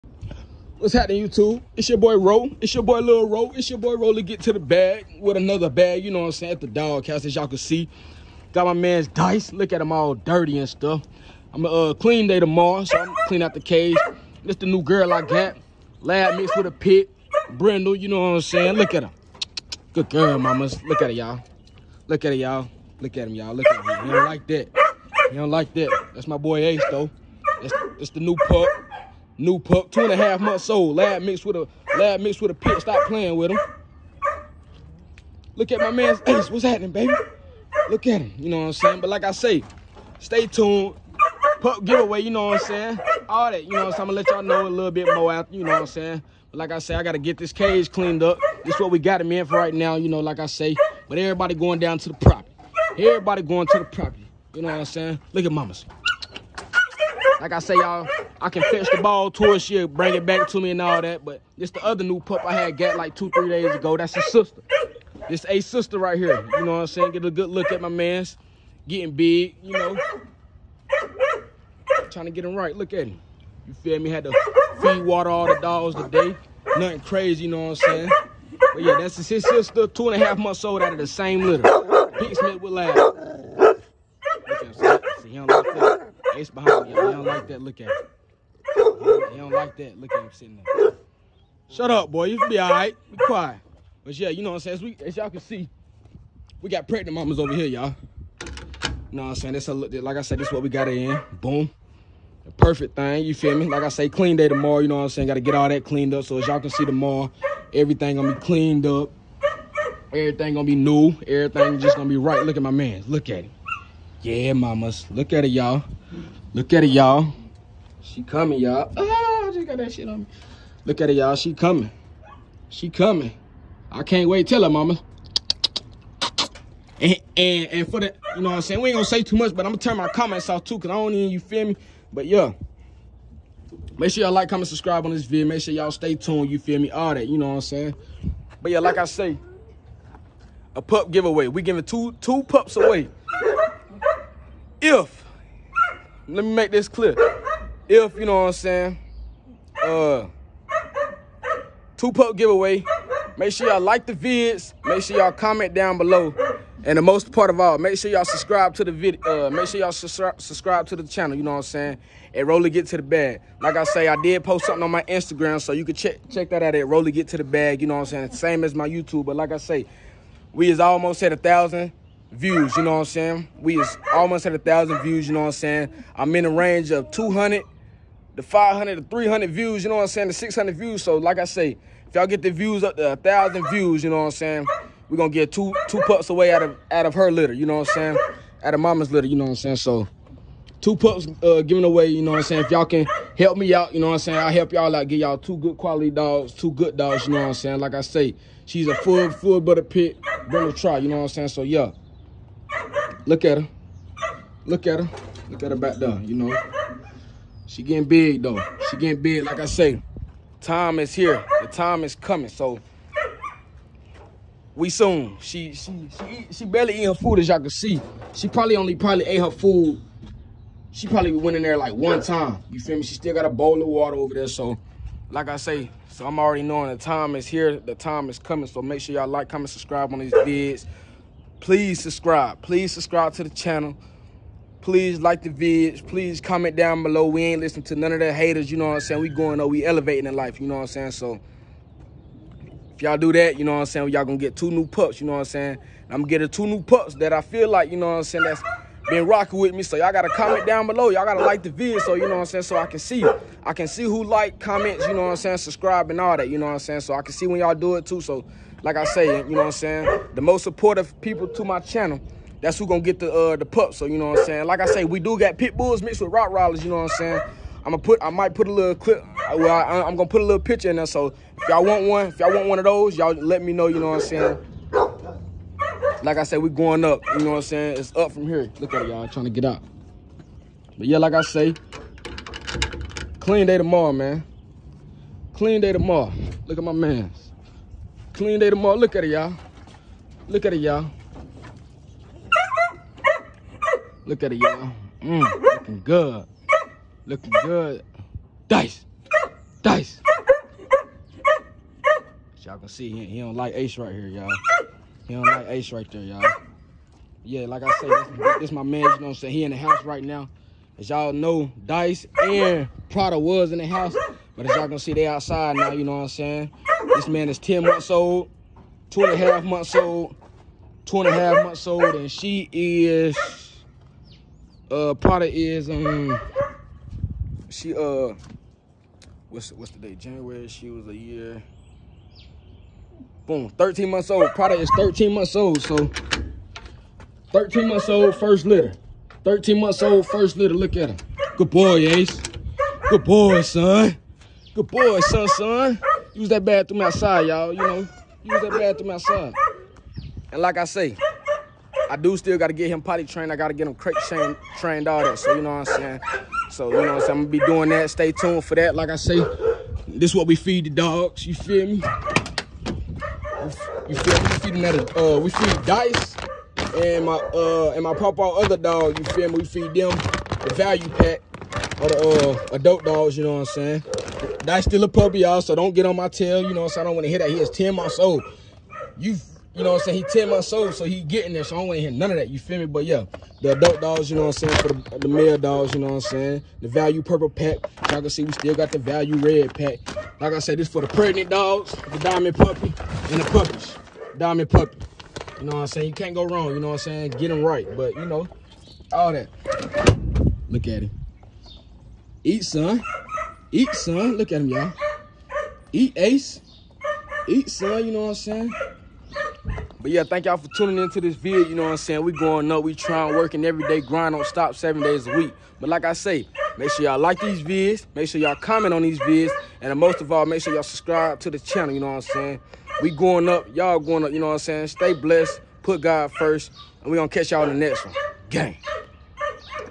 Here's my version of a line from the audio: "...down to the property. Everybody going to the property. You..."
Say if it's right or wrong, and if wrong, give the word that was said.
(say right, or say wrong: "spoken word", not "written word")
right.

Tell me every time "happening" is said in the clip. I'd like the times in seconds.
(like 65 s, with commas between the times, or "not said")
0 s, 36 s.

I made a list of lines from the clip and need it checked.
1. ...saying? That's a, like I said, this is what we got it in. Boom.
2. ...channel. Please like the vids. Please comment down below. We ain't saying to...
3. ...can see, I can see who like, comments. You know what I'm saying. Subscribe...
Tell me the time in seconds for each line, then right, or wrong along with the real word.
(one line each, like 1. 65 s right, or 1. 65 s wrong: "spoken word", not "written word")
1. 99 s right
2. 233 s wrong: "listening", not "saying"
3. 252 s right.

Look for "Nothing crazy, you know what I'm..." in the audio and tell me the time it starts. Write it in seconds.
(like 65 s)
76 s.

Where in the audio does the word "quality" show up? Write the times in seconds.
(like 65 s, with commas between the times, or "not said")
195 s.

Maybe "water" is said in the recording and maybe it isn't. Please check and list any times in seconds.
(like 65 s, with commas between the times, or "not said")
75 s, 223 s.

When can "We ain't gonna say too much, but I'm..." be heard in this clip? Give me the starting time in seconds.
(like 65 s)
128 s.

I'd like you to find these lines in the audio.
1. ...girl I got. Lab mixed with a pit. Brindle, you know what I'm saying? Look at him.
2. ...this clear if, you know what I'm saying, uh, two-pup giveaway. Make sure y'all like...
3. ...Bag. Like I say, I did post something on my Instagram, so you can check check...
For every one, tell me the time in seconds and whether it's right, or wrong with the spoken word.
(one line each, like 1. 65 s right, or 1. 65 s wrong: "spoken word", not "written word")
1. 14 s right
2. 146 s right
3. 163 s right.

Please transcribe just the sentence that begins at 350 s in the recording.
And like I say, I do still got to get him potty trained.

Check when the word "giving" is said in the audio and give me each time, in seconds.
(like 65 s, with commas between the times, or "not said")
141 s, 191 s.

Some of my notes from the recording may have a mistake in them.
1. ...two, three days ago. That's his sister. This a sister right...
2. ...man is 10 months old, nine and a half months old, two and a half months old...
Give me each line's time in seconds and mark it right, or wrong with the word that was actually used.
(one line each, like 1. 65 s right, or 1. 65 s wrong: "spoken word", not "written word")
1. 63 s right
2. 317 s wrong: "two", not "nine".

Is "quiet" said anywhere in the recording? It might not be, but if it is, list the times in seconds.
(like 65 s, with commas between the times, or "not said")
93 s.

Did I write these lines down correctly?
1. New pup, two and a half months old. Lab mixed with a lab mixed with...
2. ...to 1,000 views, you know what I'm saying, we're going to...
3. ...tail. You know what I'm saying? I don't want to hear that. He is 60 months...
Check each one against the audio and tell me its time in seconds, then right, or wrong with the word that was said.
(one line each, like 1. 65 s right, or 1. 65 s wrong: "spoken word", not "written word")
1. 29 s right
2. 182 s right
3. 376 s wrong: "10", not "60".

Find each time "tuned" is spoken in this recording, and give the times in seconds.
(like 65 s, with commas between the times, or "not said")
40 s, 136 s, 358 s.